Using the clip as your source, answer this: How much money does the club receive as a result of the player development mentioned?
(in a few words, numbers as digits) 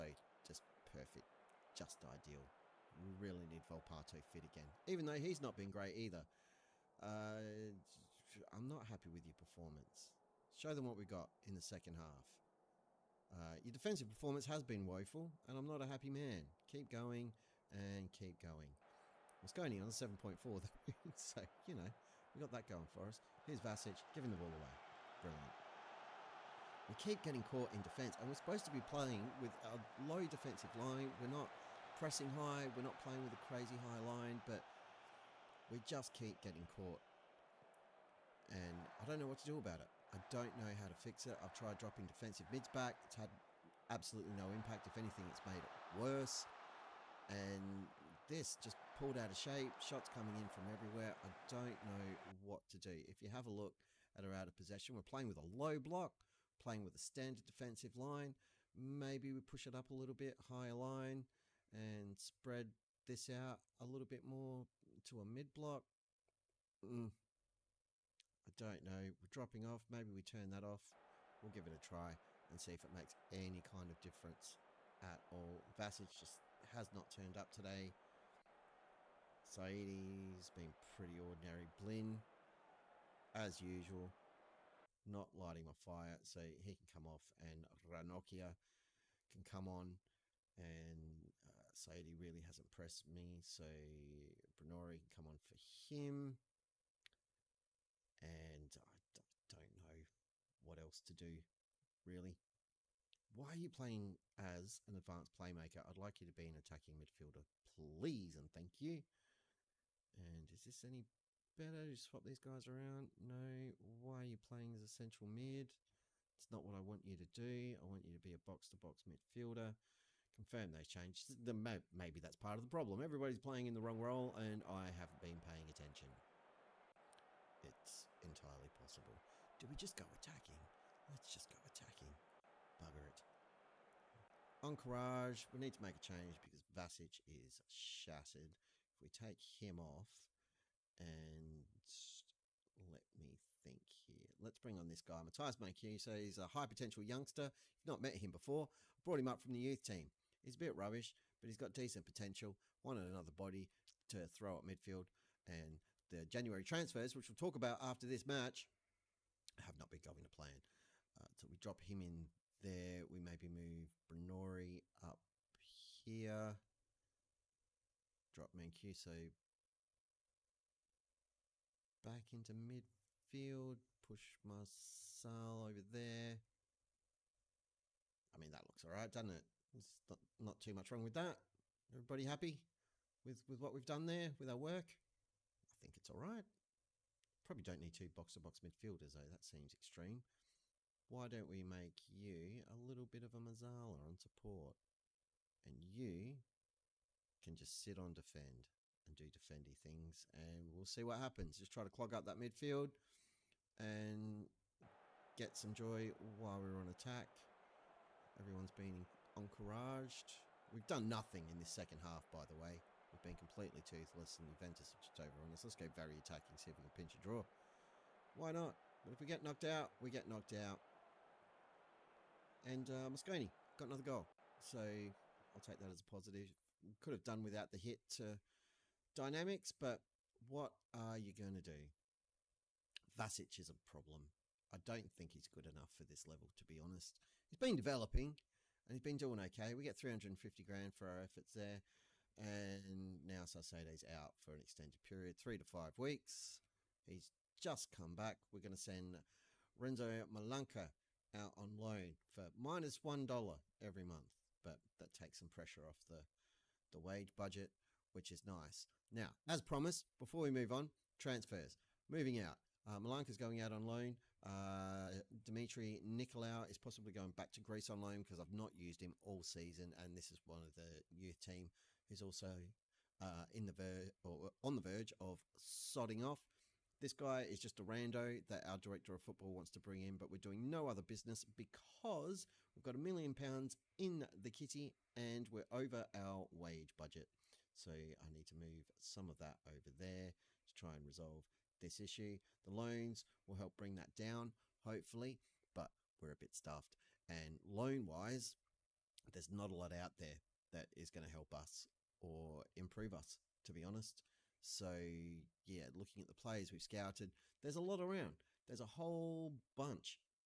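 350 grand.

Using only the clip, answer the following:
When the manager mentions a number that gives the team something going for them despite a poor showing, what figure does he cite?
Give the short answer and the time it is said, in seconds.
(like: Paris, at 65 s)
7.4, at 19 s.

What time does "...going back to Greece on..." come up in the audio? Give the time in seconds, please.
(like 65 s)
267 s.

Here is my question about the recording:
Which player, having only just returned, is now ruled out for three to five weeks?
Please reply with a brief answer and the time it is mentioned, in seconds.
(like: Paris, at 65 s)
Salcedo, at 243 s.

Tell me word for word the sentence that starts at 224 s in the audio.
So I'll take that as a positive could have done without the hit to dynamics, but what are you going to do?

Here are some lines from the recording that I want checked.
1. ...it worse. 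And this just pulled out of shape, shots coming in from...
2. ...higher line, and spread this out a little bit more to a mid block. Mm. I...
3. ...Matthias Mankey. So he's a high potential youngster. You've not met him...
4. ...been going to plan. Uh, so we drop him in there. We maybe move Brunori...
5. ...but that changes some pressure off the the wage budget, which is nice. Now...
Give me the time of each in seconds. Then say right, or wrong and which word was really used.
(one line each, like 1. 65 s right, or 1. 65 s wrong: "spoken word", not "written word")
1. 45 s right
2. 60 s right
3. 145 s right
4. 159 s right
5. 254 s wrong: "takes", not "changes".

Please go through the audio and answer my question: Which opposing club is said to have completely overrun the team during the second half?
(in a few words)
Juventus.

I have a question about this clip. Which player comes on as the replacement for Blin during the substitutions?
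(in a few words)
Ranocchia.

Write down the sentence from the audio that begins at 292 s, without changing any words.
The loans will help bring that down, hopefully, but we're a bit stuffed.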